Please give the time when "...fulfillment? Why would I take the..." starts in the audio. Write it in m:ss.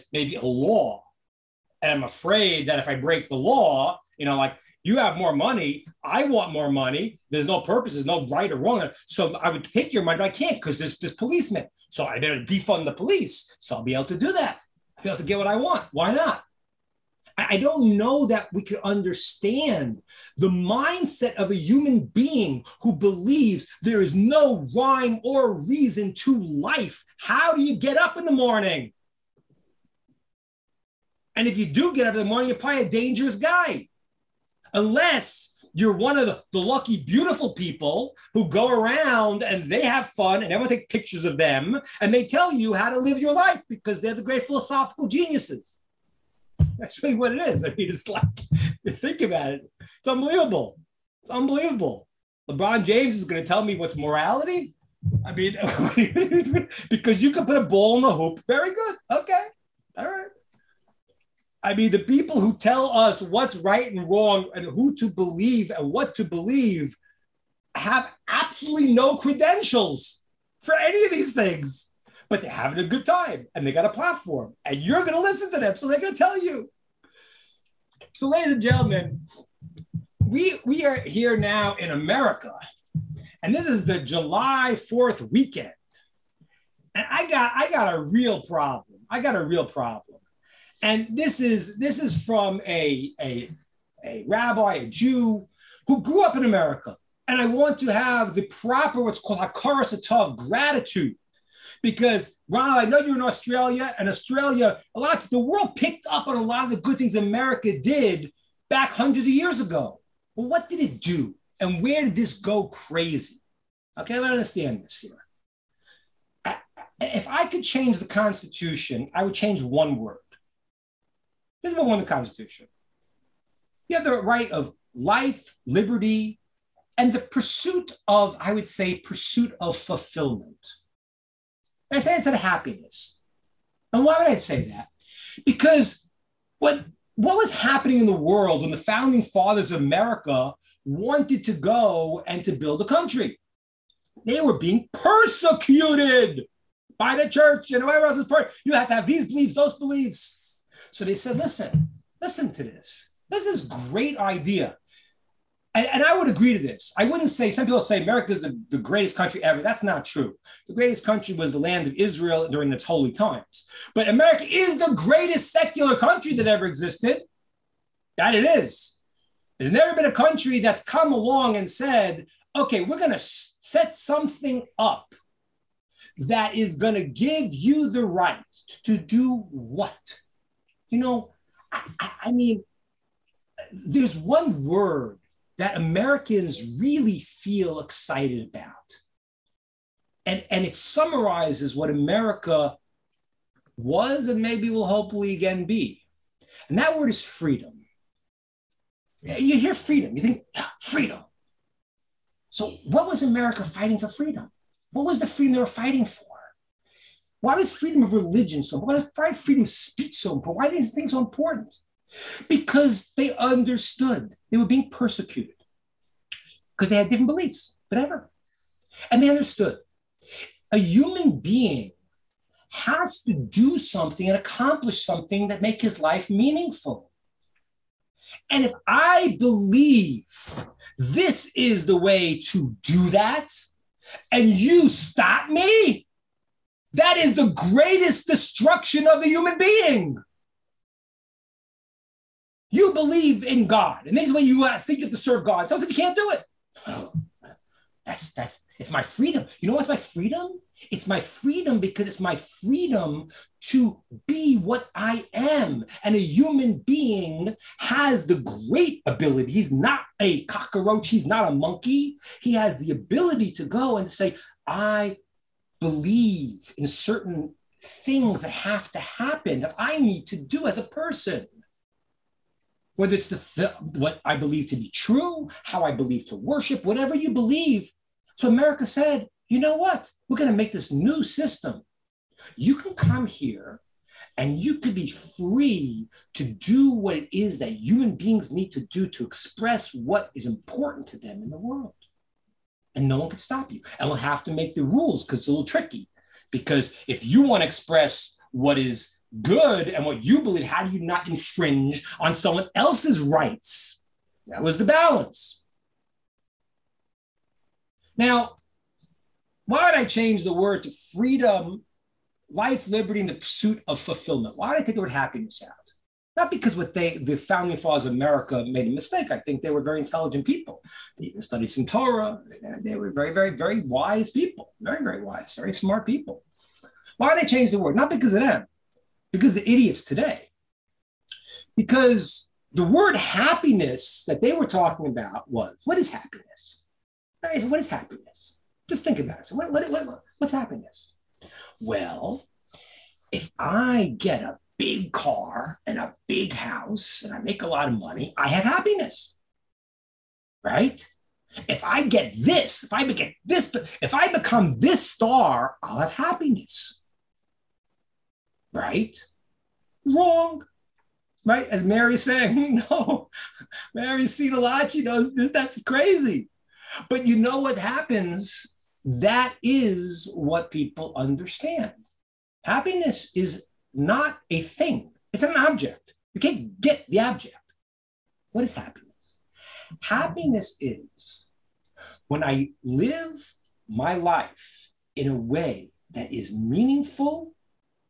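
5:13.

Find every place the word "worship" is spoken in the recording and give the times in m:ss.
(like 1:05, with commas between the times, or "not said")
4:36.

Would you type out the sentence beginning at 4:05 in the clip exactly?
Sounds like you can't do it.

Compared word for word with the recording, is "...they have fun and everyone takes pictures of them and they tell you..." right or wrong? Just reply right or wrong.
right.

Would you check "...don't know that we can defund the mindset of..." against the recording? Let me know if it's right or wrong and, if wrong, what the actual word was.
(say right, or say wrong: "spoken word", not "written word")
wrong: "understand", not "defund".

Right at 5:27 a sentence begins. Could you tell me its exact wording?
Not because of them, because the idiots today.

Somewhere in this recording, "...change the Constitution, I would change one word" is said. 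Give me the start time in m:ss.
1:57.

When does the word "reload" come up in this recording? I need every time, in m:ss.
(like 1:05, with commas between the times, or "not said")
not said.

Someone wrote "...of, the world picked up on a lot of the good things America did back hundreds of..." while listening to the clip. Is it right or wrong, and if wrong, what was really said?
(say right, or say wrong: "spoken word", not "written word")
right.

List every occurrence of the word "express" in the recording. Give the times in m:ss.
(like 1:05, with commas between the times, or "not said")
4:49, 4:57.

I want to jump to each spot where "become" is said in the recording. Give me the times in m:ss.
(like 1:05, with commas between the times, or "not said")
5:54.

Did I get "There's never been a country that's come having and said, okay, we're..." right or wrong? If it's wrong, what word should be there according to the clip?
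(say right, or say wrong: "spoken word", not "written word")
wrong: "along", not "having".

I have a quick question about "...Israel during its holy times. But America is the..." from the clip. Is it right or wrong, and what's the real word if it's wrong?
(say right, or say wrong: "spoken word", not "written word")
right.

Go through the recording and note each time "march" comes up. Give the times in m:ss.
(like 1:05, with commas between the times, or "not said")
not said.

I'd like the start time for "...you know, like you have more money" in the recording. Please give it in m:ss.
0:04.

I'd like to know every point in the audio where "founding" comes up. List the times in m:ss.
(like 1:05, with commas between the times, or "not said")
2:18, 5:17.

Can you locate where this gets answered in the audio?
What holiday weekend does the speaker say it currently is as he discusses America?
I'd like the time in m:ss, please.
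1:23.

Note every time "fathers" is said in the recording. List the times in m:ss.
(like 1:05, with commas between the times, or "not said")
2:19, 5:17.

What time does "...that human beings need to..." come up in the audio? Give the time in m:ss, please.
4:47.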